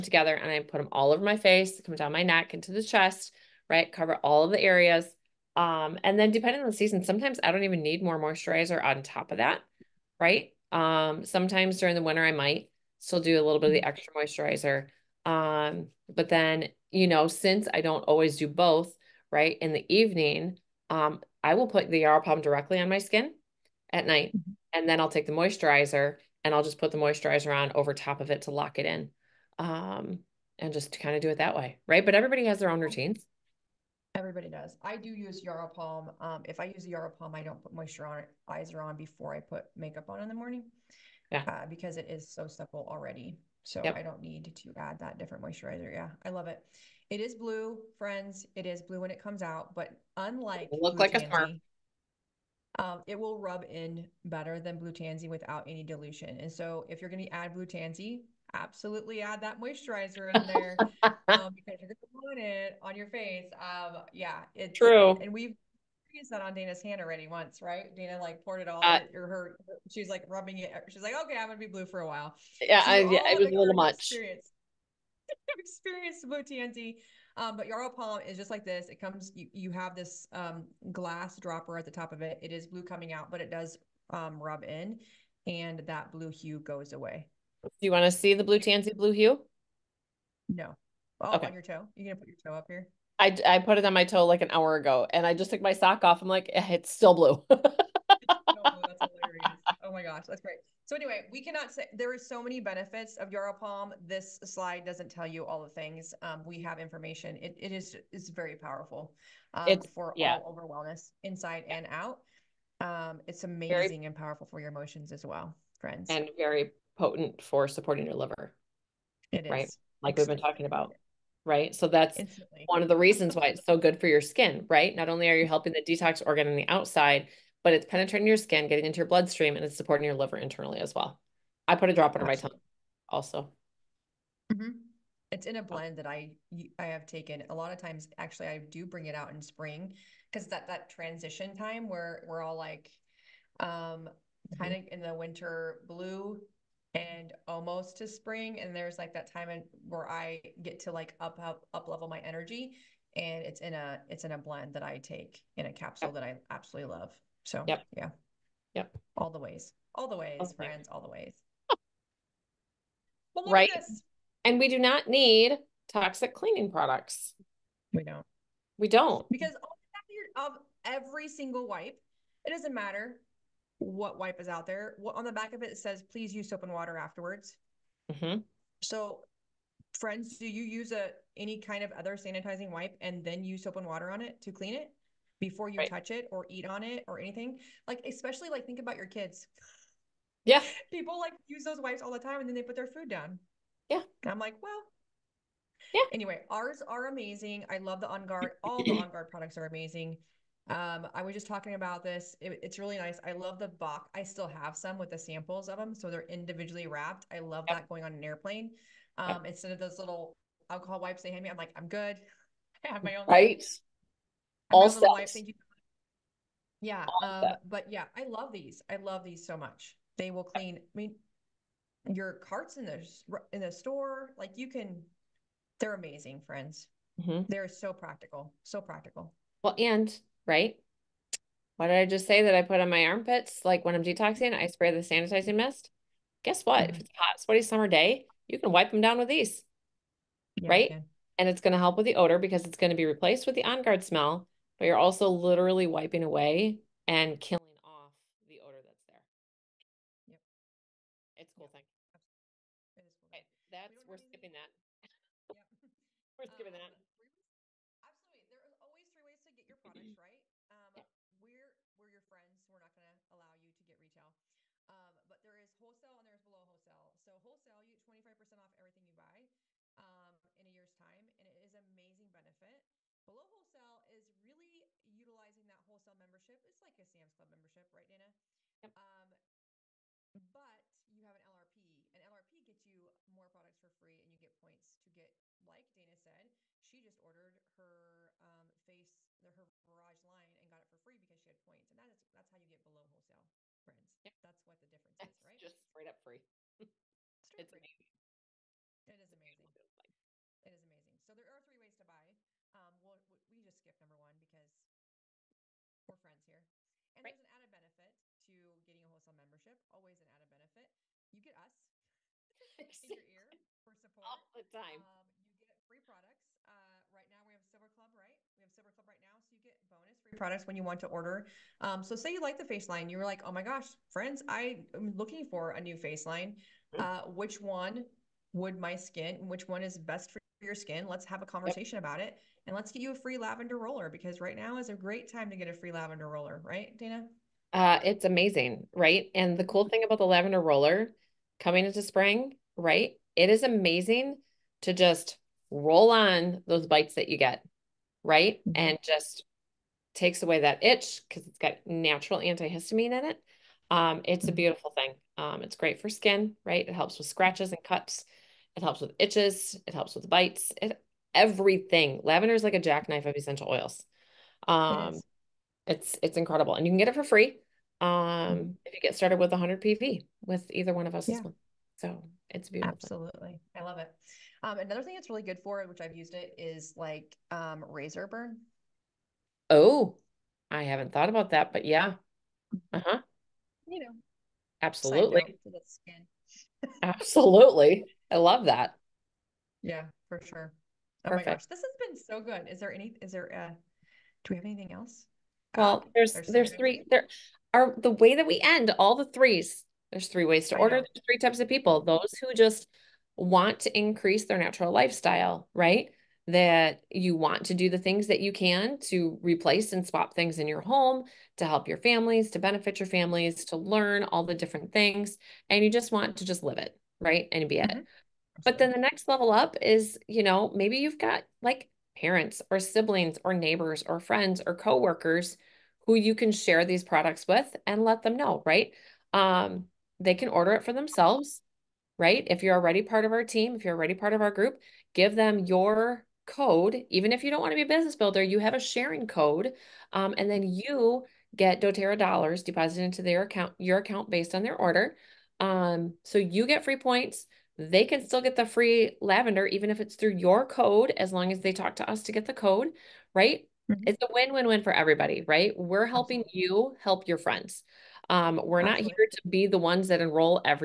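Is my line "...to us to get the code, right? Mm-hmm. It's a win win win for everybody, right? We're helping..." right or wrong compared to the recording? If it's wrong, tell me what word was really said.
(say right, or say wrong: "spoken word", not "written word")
right.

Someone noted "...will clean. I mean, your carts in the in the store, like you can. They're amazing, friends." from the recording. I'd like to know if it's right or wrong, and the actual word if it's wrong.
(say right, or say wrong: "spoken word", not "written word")
right.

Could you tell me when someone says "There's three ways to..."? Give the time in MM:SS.
06:40.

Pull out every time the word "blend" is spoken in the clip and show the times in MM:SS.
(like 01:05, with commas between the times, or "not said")
02:15, 02:34.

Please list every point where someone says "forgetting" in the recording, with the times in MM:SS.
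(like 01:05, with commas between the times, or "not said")
not said.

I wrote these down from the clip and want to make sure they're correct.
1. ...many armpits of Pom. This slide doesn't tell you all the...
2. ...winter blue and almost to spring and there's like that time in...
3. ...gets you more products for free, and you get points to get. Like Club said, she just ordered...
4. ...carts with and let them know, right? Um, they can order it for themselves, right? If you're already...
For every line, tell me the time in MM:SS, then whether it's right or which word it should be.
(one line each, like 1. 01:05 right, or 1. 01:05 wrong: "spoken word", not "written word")
1. 01:42 wrong: "benefits", not "armpits"
2. 02:25 right
3. 04:42 wrong: "Dana", not "Club"
4. 07:07 wrong: "products", not "carts".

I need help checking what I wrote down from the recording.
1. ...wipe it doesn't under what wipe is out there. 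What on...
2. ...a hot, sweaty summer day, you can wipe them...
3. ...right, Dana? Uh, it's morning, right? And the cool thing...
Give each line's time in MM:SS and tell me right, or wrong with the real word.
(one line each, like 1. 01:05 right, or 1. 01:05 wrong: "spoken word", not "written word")
1. 02:51 wrong: "matter", not "under"
2. 03:57 right
3. 05:36 wrong: "amazing", not "morning".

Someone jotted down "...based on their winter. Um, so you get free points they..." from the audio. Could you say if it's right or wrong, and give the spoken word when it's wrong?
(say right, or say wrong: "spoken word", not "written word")
wrong: "order", not "winter".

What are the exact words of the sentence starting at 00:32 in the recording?
But everybody has their own routines.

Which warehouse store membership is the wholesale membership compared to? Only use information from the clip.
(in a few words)
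Sam's Club.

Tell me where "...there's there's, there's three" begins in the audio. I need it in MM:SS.
06:36.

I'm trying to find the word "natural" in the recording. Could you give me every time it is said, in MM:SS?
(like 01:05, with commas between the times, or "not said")
05:51, 06:44.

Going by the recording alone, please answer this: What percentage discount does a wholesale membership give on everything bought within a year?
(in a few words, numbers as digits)
25%.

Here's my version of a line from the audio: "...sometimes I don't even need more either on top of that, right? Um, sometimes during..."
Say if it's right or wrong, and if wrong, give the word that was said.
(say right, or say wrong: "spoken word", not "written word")
wrong: "moisturizer", not "either".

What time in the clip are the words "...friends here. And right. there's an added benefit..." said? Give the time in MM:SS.
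05:06.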